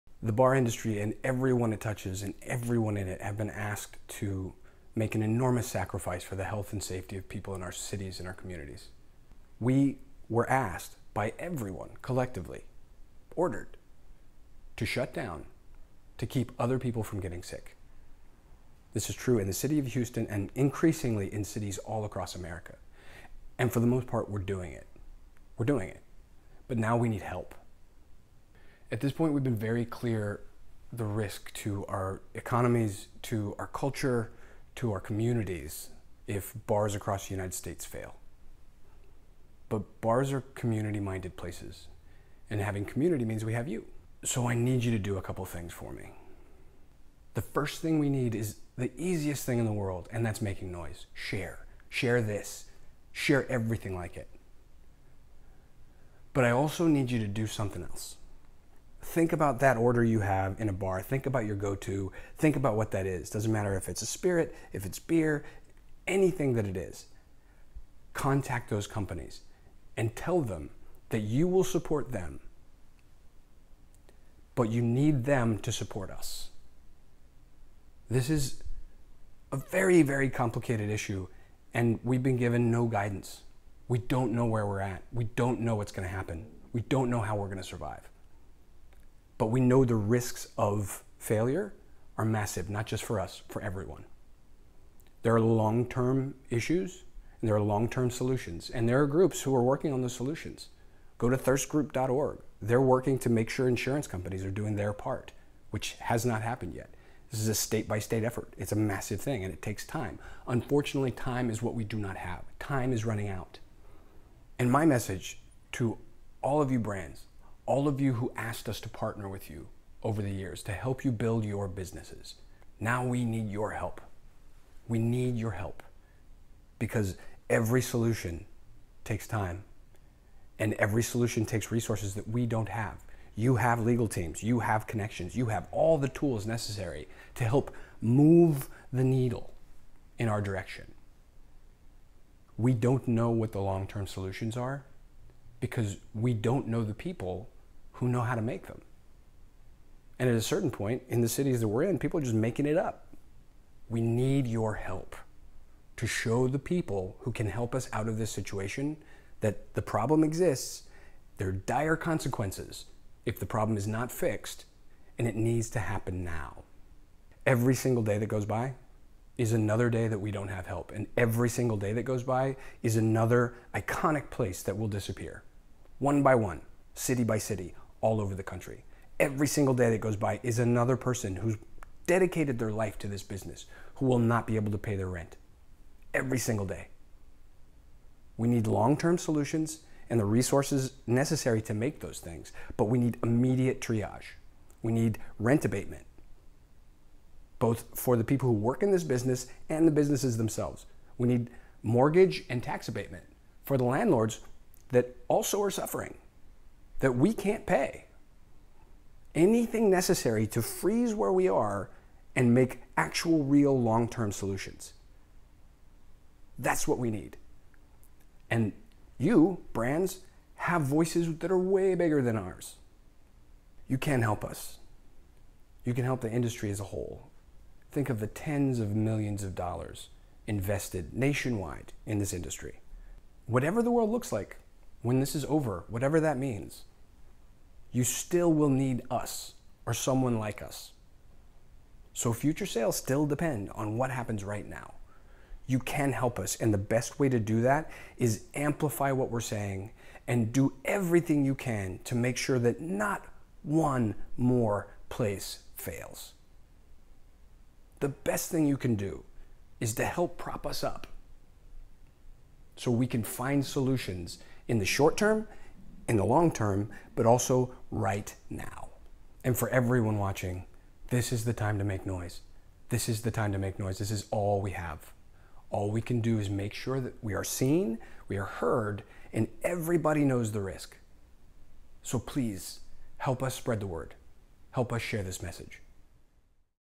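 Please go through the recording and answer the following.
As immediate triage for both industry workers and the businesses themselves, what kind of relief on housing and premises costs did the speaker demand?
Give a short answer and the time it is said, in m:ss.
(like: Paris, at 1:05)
Rent abatement, at 3:15.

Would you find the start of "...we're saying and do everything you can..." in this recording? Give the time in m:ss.
4:09.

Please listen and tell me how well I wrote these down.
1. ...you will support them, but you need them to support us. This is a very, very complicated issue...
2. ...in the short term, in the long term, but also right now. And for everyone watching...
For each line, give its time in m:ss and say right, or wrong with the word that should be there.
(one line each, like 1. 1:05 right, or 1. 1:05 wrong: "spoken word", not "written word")
1. 1:11 right
2. 4:24 right.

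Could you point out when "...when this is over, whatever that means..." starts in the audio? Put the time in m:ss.
3:55.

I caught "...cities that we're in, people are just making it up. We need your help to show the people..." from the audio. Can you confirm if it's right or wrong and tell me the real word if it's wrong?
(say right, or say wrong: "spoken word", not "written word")
right.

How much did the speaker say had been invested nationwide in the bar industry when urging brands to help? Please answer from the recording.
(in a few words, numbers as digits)
Tens of millions of dollars.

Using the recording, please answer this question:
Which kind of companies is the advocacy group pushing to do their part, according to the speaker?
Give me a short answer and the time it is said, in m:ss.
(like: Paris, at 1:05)
Insurance companies, at 1:43.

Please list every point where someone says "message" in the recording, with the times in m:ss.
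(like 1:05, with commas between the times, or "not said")
1:54, 4:45.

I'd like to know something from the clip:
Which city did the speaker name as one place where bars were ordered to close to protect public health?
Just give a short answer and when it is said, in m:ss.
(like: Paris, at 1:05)
Houston, at 0:19.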